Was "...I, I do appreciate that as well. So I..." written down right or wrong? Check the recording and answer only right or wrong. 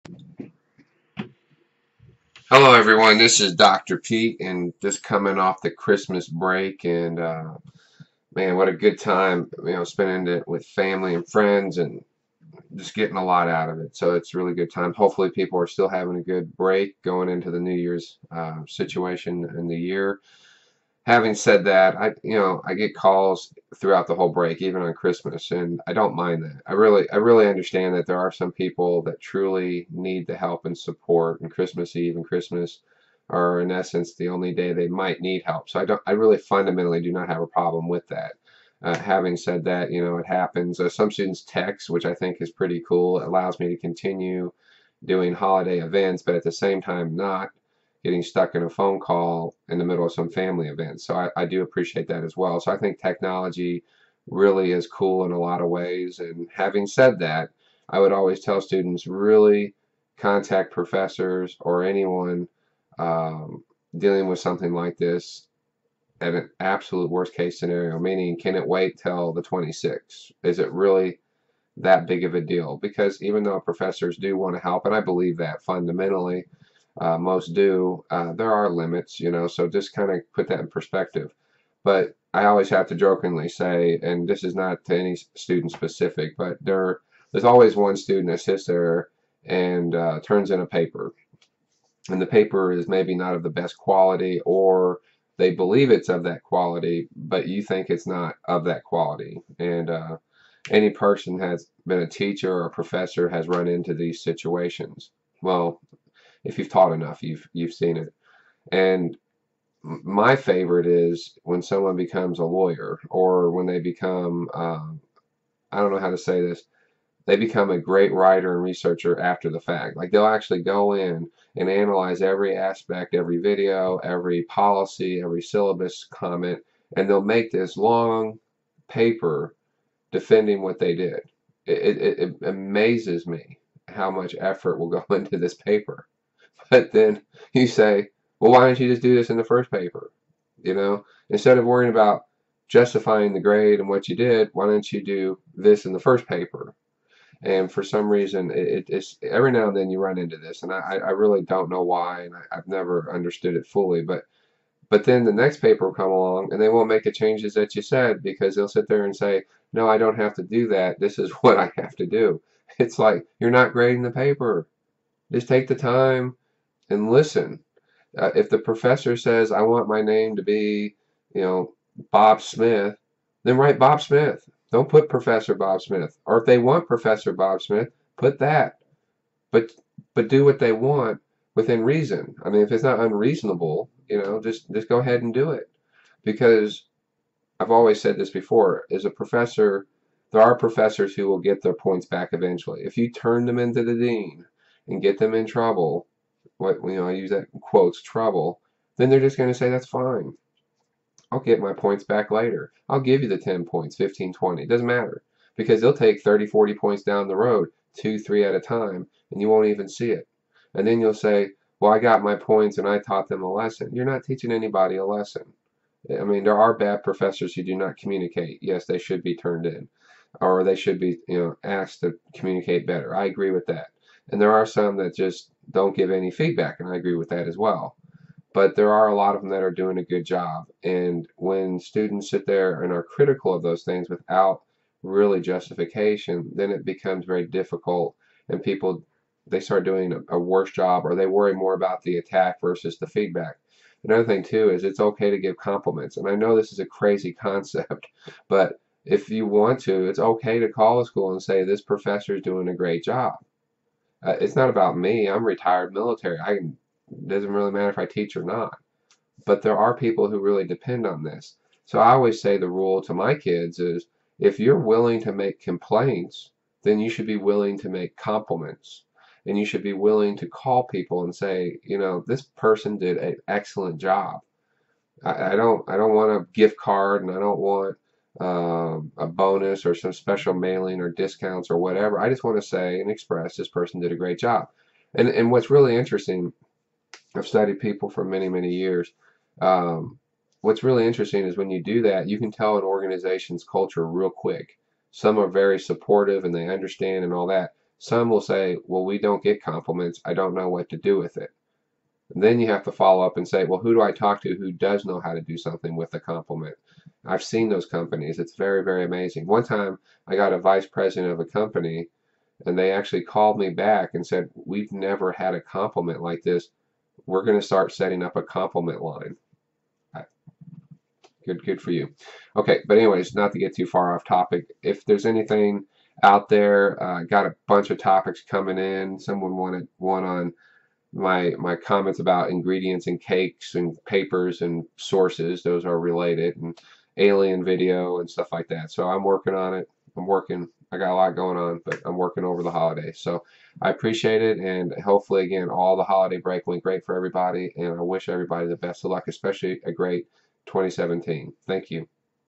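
right.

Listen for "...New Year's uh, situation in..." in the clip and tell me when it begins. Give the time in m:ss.
0:17.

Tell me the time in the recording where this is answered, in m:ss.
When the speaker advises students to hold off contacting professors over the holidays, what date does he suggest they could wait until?
1:09.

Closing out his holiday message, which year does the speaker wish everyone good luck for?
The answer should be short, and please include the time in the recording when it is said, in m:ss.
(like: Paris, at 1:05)
2017, at 5:50.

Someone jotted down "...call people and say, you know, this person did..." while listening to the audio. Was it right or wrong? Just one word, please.
right.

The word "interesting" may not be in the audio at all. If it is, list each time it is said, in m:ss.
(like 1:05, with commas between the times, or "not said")
4:45, 4:51.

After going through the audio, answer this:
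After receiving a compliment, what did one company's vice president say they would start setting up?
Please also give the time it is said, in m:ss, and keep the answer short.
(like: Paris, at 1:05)
a compliment line, at 5:18.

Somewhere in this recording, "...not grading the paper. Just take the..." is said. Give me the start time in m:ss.
2:43.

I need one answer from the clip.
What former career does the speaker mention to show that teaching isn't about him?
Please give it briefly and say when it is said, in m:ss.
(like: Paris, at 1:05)
retired military, at 4:15.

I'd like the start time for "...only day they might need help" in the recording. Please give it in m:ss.
0:34.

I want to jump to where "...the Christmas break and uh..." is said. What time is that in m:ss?
0:05.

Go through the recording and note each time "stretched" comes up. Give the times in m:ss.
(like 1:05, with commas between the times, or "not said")
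not said.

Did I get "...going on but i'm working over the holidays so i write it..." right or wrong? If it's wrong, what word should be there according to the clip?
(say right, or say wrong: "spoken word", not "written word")
wrong: "appreciate", not "write".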